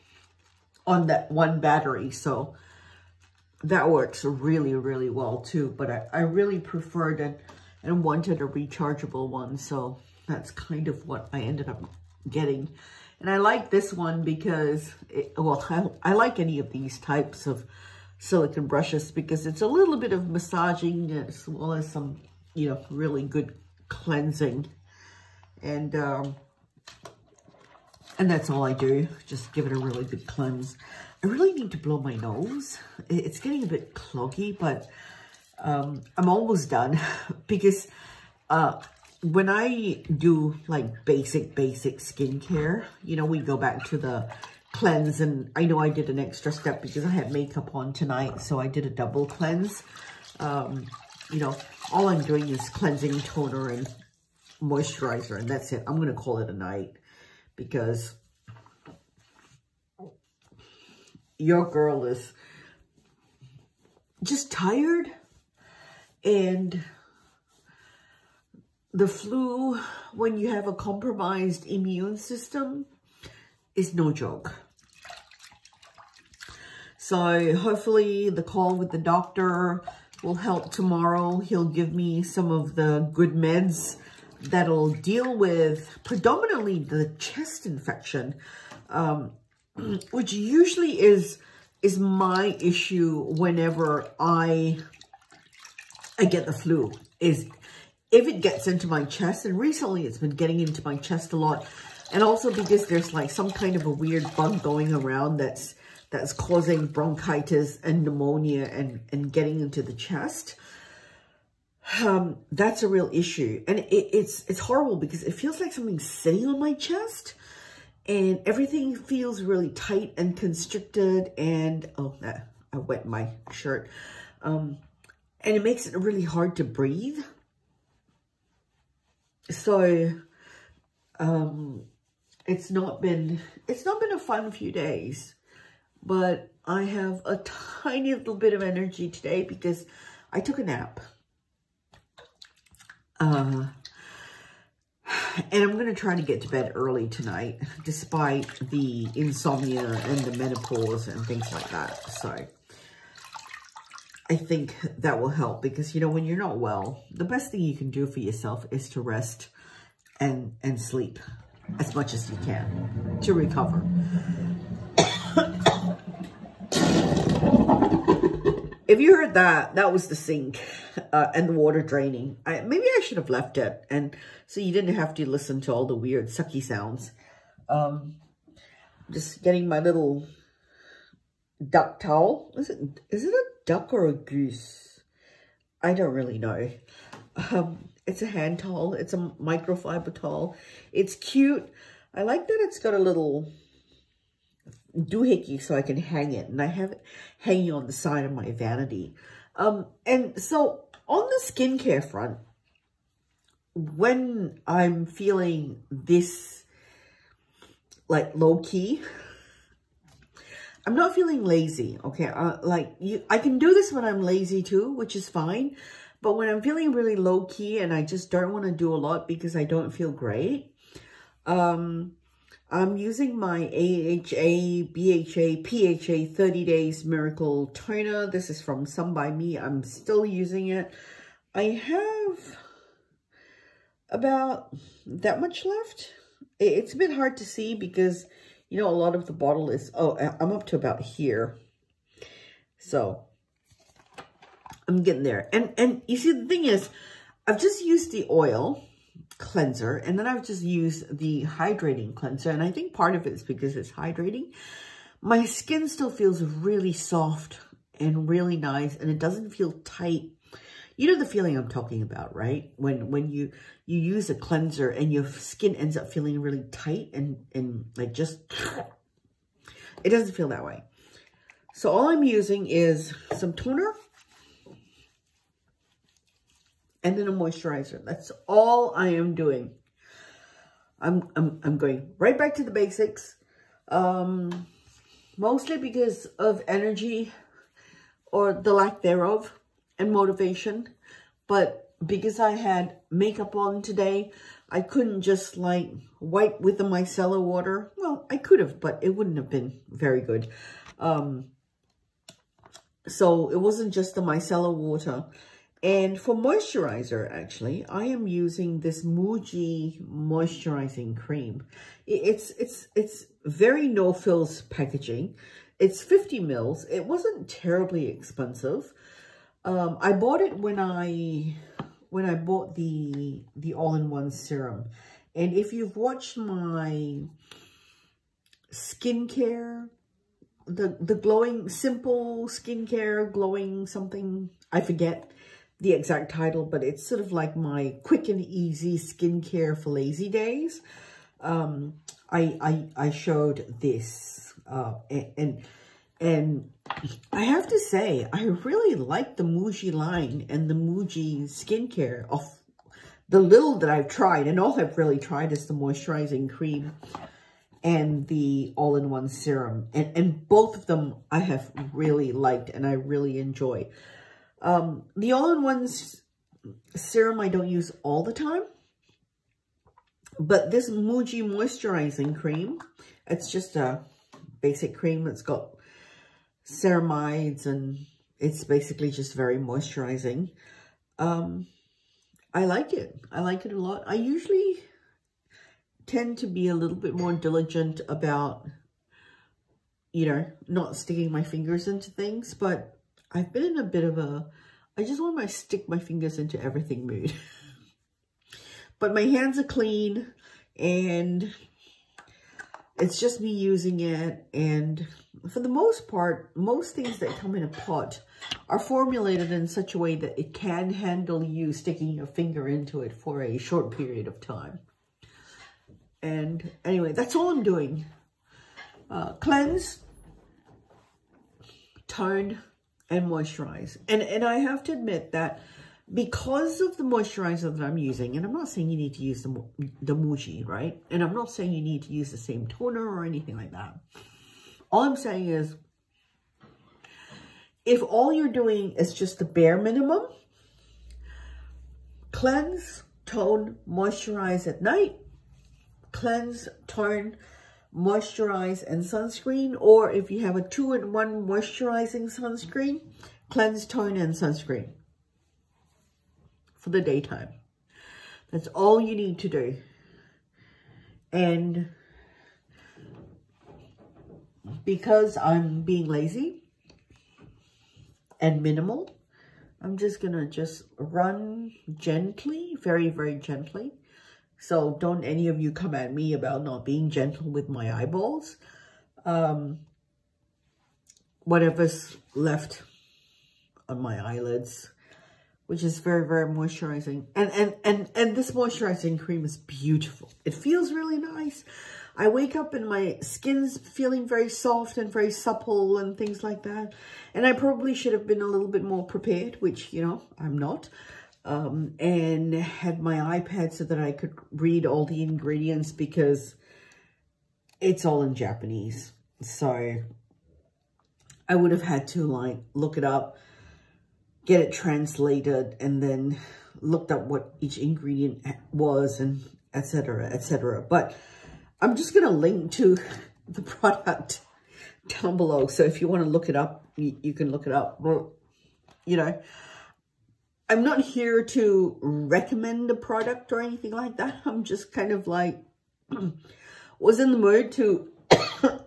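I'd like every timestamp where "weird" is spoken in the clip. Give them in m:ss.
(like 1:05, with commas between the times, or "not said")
1:43, 2:55.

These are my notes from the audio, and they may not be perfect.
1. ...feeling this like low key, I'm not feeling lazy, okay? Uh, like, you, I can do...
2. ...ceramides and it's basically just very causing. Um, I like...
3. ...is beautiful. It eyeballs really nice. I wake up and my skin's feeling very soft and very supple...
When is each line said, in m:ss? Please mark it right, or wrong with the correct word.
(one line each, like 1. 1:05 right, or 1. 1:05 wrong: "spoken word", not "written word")
1. 3:25 right
2. 6:16 wrong: "moisturizing", not "causing"
3. 8:09 wrong: "feels", not "eyeballs".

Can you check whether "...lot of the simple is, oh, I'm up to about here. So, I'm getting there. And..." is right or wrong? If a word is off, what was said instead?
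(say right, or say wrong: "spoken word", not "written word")
wrong: "bottle", not "simple".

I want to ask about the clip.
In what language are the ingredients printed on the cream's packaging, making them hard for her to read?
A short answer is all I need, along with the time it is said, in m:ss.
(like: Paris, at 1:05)
Japanese, at 8:28.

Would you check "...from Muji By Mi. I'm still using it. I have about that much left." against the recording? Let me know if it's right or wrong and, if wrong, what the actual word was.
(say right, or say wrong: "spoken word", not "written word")
wrong: "Some", not "Muji".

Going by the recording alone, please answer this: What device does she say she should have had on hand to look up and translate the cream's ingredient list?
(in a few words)
iPad.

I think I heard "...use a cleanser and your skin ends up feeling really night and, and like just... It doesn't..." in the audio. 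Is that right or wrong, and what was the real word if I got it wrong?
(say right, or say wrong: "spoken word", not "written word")
wrong: "tight", not "night".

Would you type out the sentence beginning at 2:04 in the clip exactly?
Um, and it makes it really hard to breathe.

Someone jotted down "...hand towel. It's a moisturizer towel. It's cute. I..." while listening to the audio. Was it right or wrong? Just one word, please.
wrong.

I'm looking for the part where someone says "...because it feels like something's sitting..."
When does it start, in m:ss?
1:54.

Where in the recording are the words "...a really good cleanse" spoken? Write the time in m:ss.
0:29.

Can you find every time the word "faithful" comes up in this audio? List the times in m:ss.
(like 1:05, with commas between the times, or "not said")
not said.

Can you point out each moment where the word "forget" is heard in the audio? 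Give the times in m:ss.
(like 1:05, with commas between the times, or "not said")
5:34.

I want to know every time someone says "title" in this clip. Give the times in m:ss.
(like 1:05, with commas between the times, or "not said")
5:36.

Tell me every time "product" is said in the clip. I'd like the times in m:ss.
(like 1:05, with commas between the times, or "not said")
8:43, 8:52.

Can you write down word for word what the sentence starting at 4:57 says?
Well, I could have, but it wouldn't have been very good.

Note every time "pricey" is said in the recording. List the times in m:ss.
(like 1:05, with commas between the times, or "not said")
not said.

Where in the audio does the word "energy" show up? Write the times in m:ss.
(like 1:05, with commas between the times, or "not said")
2:18, 4:46.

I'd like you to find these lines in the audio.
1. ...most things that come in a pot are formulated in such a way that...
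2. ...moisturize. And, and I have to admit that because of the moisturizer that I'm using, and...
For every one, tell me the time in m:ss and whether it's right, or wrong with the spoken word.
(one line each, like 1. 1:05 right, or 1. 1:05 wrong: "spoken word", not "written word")
1. 6:46 right
2. 7:03 right.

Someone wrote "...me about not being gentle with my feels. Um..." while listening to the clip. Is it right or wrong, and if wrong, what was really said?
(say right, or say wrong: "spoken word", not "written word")
wrong: "eyeballs", not "feels".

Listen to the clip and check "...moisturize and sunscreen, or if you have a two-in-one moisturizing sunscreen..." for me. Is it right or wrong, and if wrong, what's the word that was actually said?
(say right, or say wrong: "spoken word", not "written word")
right.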